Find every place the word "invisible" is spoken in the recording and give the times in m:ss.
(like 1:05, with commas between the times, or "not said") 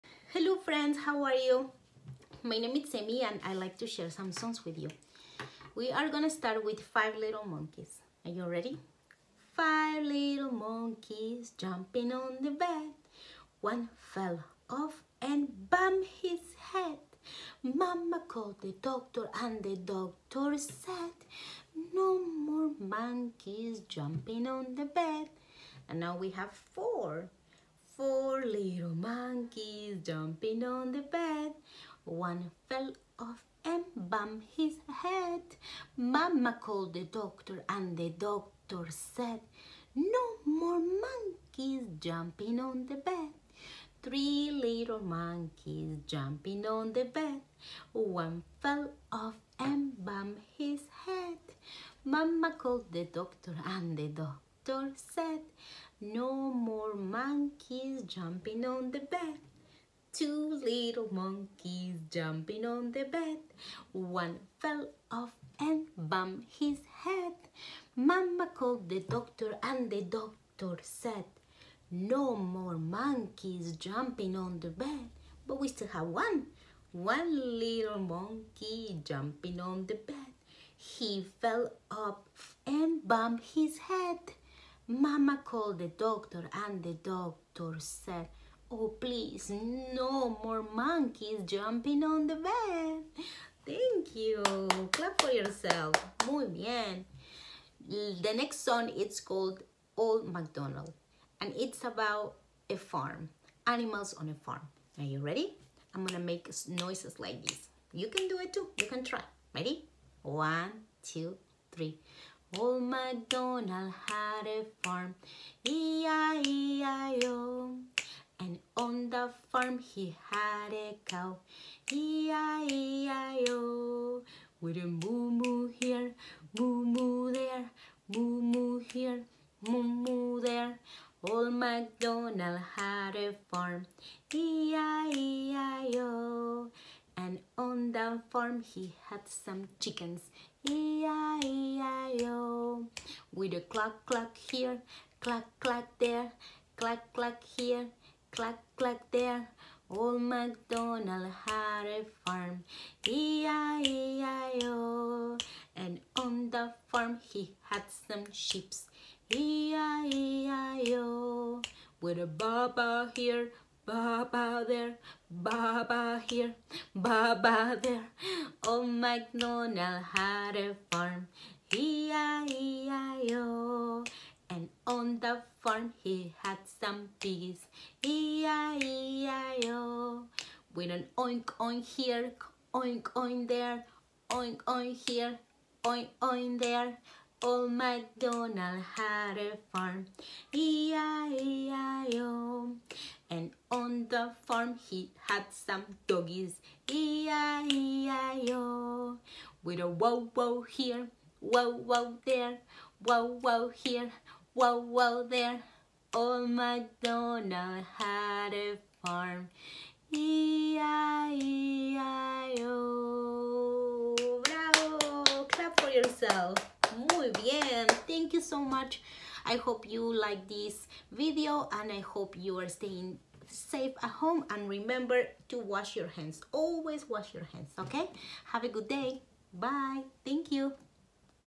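not said.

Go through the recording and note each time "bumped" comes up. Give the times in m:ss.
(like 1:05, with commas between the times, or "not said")
0:15, 0:34, 0:50, 1:05, 1:23.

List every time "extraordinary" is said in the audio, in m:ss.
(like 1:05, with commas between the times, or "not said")
not said.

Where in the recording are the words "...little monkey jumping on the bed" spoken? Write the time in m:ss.
1:17.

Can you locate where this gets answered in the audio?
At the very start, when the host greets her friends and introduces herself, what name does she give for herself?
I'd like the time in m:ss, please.
0:02.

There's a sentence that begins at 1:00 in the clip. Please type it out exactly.
Two little monkeys jumping on the bed.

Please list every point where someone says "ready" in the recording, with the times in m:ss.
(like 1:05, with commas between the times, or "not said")
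0:08, 1:45, 1:49.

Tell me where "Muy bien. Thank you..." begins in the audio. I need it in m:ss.
3:37.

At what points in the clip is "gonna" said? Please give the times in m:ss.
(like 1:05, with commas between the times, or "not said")
0:06, 1:46.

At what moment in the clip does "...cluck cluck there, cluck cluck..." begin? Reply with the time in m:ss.
2:25.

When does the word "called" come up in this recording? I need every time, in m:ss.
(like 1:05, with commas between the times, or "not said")
0:18, 0:36, 0:52, 1:08, 1:25, 1:39.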